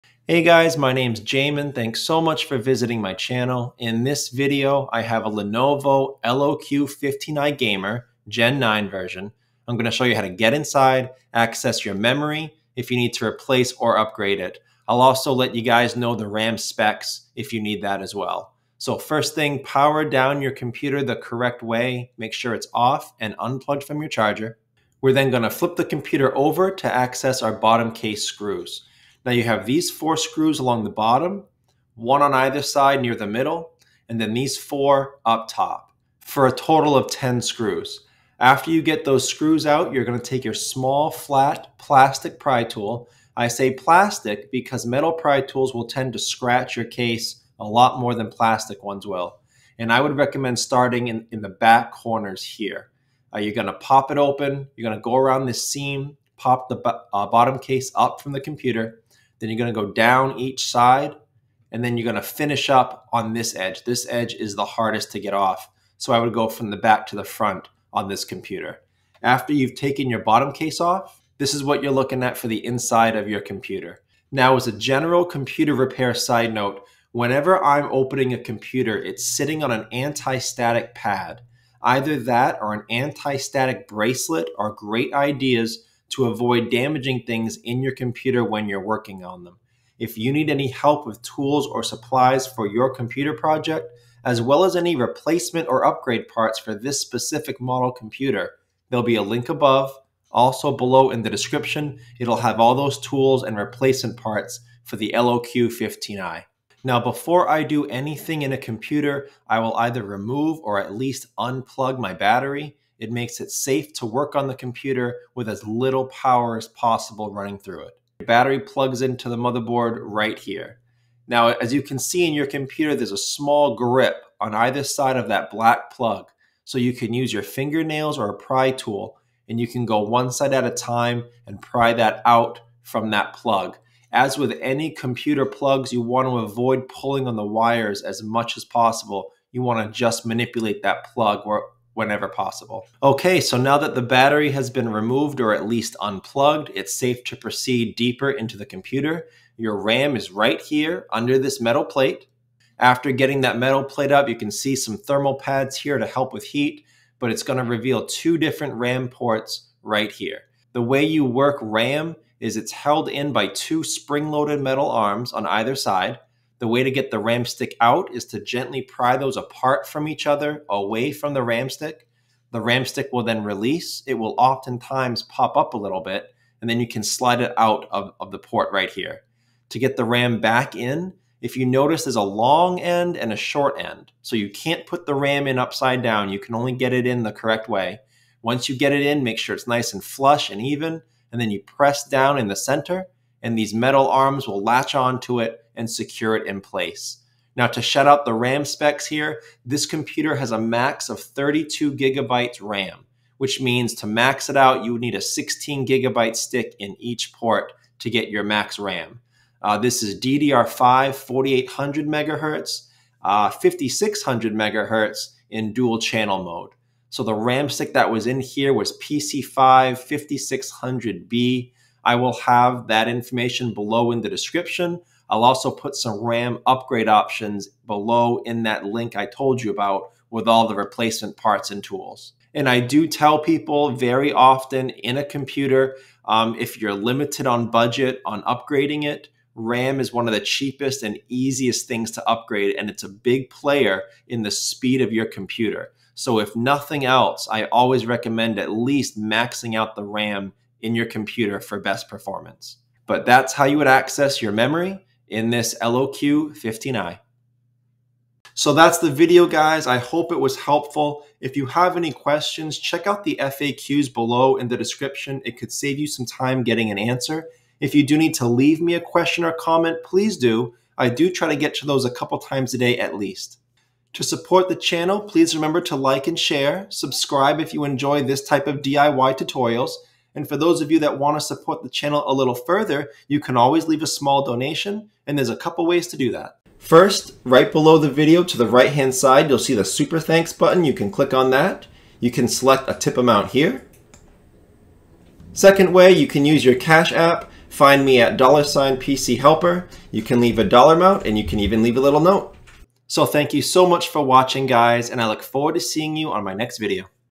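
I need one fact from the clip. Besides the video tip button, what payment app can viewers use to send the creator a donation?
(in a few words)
Cash App.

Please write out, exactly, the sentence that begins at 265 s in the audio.
It could save you some time getting an answer.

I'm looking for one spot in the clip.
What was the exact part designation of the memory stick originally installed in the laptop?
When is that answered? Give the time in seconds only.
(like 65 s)
218 s.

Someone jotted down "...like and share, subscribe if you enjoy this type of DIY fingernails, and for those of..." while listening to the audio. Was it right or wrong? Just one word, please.
wrong.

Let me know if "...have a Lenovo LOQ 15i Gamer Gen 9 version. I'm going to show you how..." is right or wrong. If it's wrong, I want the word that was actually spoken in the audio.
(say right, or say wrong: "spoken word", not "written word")
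right.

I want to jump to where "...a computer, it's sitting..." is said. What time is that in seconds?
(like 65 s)
78 s.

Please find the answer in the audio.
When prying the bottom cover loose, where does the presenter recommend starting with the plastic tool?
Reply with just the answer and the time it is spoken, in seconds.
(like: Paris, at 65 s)
back corners, at 51 s.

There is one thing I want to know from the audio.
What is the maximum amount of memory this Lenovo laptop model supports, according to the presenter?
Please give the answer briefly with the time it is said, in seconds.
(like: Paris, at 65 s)
32 GB, at 201 s.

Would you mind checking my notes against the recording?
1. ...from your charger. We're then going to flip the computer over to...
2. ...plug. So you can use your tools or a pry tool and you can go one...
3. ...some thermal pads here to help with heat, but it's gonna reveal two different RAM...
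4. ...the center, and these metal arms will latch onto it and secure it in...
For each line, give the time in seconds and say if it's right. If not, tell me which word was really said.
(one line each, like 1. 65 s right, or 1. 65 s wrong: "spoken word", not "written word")
1. 23 s right
2. 125 s wrong: "fingernails", not "tools"
3. 154 s right
4. 192 s right.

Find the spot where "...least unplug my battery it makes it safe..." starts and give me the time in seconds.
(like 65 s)
110 s.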